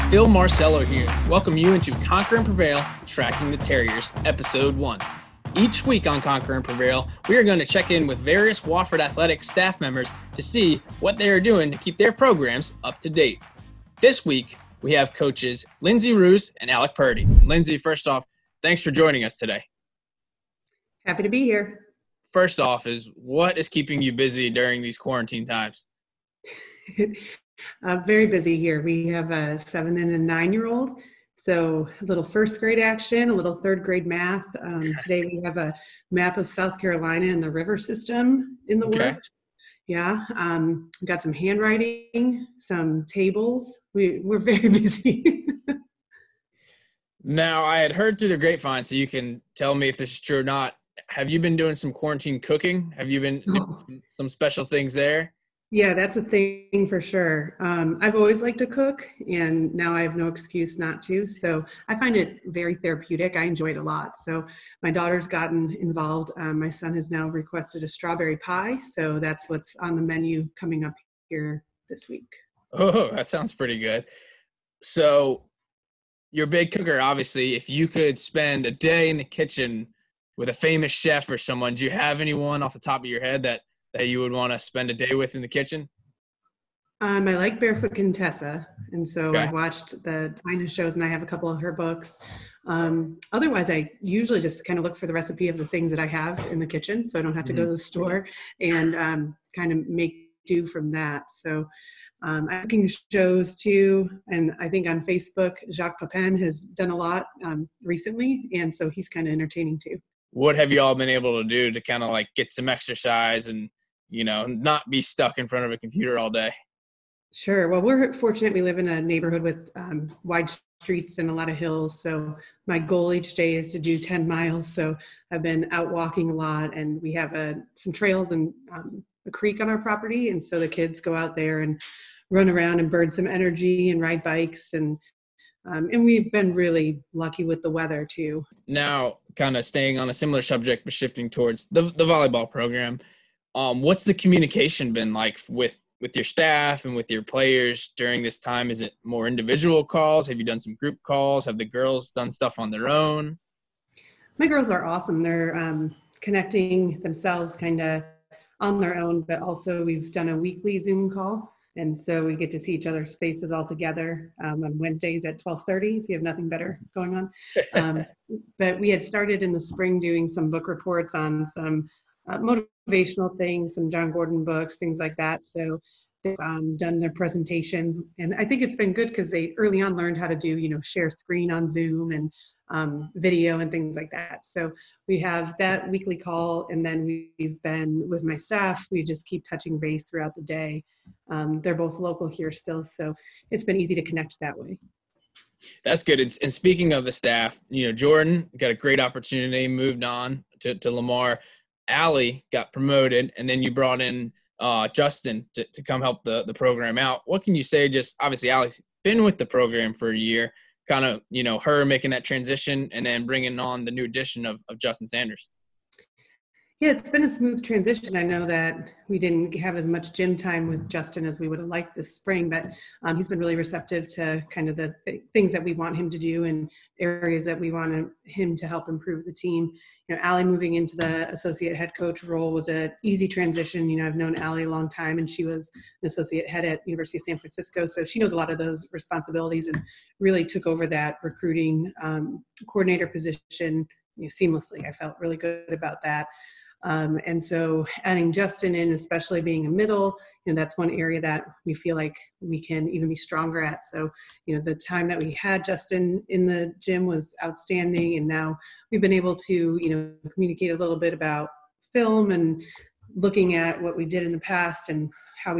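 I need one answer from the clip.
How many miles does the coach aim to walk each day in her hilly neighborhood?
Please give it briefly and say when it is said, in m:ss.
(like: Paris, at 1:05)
10, at 2:03.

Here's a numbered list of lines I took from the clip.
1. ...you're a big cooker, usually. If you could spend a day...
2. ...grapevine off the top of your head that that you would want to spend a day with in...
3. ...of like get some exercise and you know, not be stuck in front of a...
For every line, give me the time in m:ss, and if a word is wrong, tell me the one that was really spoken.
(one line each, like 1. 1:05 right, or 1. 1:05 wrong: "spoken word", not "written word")
1. 1:16 wrong: "obviously", not "usually"
2. 1:22 wrong: "anyone", not "grapevine"
3. 1:52 right.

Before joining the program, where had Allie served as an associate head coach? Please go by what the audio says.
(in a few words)
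University of San Francisco.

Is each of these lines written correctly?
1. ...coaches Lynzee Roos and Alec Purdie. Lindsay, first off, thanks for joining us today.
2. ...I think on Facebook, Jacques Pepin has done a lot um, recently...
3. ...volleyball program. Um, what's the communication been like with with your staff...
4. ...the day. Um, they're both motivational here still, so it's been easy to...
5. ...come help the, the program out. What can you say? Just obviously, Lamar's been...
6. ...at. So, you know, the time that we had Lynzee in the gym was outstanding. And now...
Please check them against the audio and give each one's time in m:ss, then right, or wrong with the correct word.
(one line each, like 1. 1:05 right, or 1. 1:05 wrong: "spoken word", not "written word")
1. 0:15 right
2. 1:44 right
3. 2:22 right
4. 3:10 wrong: "local", not "motivational"
5. 3:25 wrong: "Allie", not "Lamar"
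6. 4:13 wrong: "Justin", not "Lynzee".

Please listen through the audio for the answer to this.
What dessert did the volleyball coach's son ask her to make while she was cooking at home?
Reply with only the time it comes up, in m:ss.
1:07.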